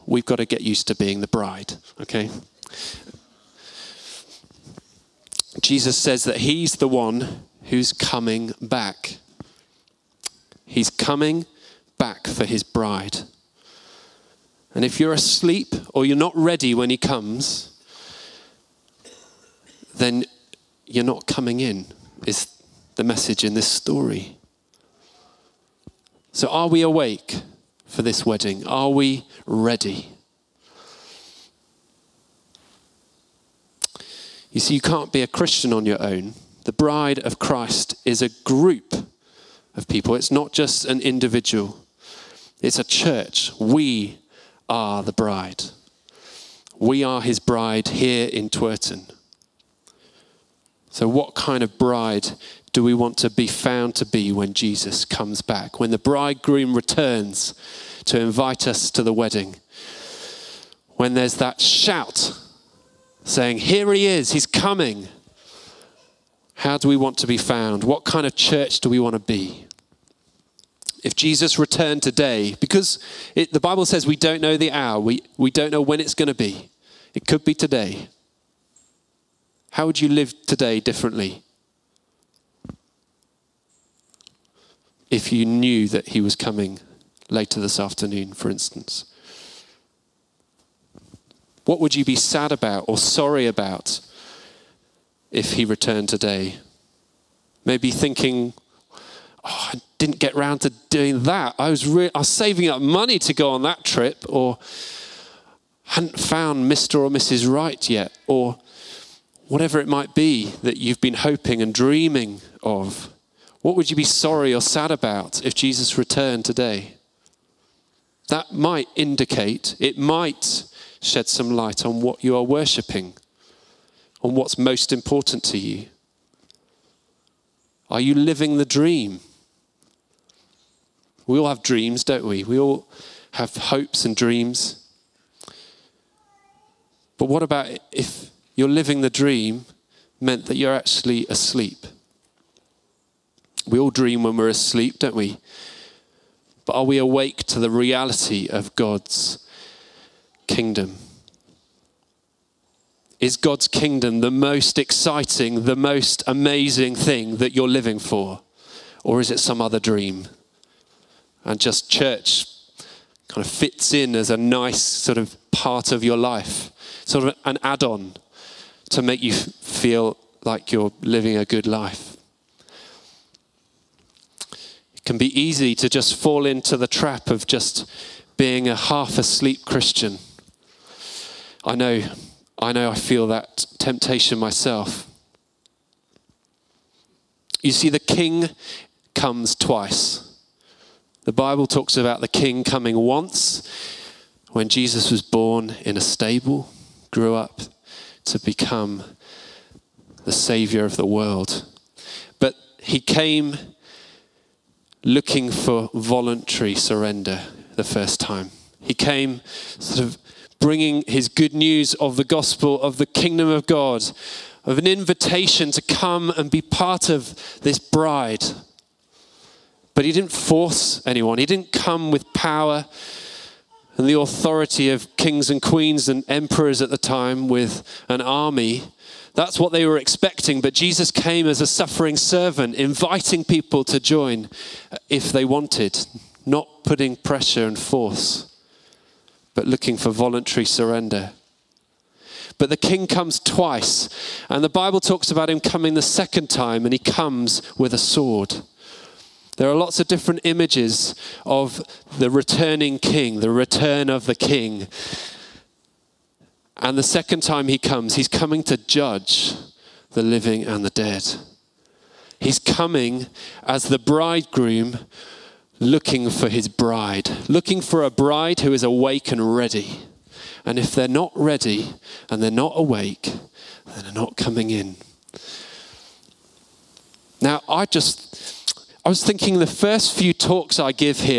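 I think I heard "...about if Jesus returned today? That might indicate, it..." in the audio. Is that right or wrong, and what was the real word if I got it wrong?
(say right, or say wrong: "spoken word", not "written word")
right.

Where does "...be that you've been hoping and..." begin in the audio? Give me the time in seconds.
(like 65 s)
110 s.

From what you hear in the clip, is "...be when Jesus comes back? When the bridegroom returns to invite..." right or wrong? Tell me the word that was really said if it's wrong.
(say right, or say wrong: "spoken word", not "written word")
right.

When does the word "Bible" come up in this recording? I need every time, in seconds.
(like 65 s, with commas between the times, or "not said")
73 s, 191 s, 244 s.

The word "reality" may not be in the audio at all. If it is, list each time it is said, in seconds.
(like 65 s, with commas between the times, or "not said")
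147 s.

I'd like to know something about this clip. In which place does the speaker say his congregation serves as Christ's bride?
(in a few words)
Twerton.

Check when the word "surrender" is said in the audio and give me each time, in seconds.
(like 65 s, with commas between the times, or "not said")
206 s, 240 s.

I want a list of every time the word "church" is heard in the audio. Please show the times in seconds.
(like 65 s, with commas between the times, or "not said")
42 s, 68 s, 161 s.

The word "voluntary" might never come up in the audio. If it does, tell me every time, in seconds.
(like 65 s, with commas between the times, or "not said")
205 s, 240 s.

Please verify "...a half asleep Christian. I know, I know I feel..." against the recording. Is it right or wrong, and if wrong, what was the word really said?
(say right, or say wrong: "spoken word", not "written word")
right.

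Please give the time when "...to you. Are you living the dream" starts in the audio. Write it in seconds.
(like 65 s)
125 s.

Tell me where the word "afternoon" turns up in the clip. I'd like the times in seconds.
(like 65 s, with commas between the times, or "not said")
87 s.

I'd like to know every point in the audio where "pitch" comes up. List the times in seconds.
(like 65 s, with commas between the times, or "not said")
not said.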